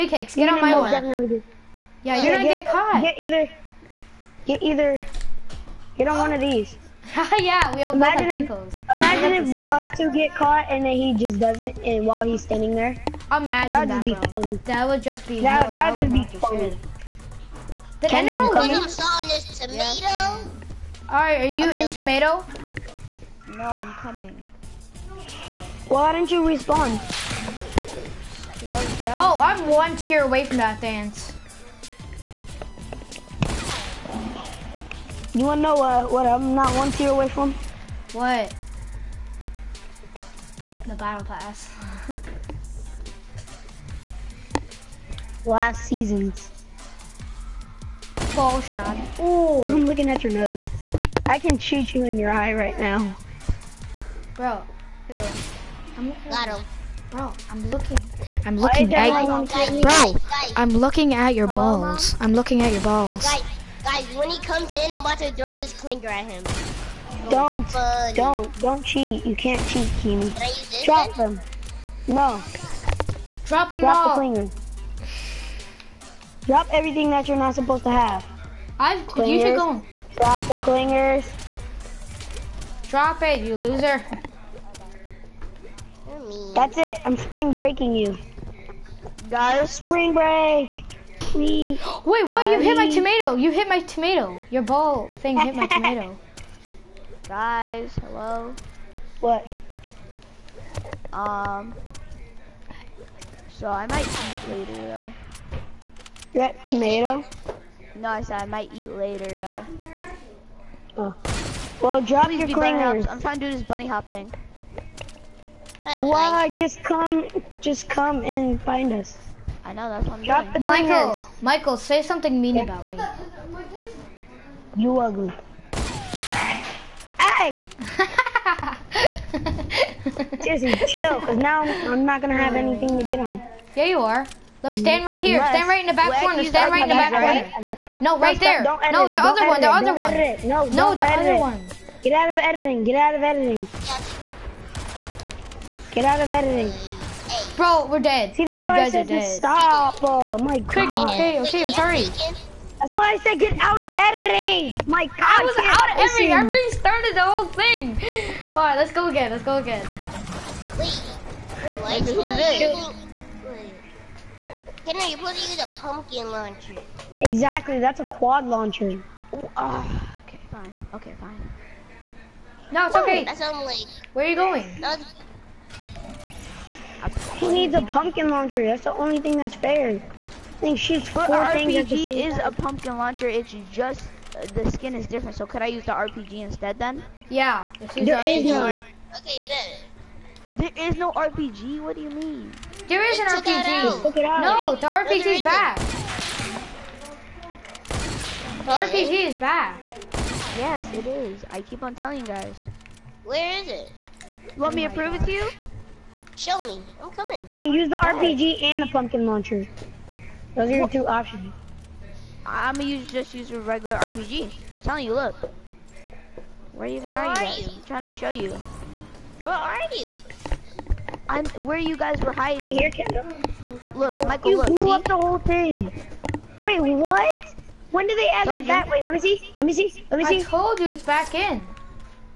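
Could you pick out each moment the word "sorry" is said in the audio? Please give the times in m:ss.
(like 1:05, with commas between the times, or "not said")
2:31.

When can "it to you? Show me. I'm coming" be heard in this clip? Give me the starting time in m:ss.
3:25.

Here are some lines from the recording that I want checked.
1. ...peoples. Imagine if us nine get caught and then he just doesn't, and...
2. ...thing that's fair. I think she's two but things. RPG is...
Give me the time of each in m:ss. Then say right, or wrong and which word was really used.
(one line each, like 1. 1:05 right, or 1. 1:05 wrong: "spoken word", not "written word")
1. 0:08 wrong: "two", not "nine"
2. 2:59 wrong: "four", not "two".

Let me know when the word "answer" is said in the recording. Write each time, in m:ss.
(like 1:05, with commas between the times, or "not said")
not said.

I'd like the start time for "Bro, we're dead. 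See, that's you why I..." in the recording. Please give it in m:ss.
2:27.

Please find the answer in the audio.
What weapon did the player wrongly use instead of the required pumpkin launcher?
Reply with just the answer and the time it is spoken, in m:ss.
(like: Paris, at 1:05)
quad launcher, at 2:48.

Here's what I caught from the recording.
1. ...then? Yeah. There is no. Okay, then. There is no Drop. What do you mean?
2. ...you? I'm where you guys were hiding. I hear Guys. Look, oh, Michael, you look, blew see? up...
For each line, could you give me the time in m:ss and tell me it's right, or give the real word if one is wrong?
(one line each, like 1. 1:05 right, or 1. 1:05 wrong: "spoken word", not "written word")
1. 3:06 wrong: "RPG", not "Drop"
2. 3:39 wrong: "Kendall", not "Guys".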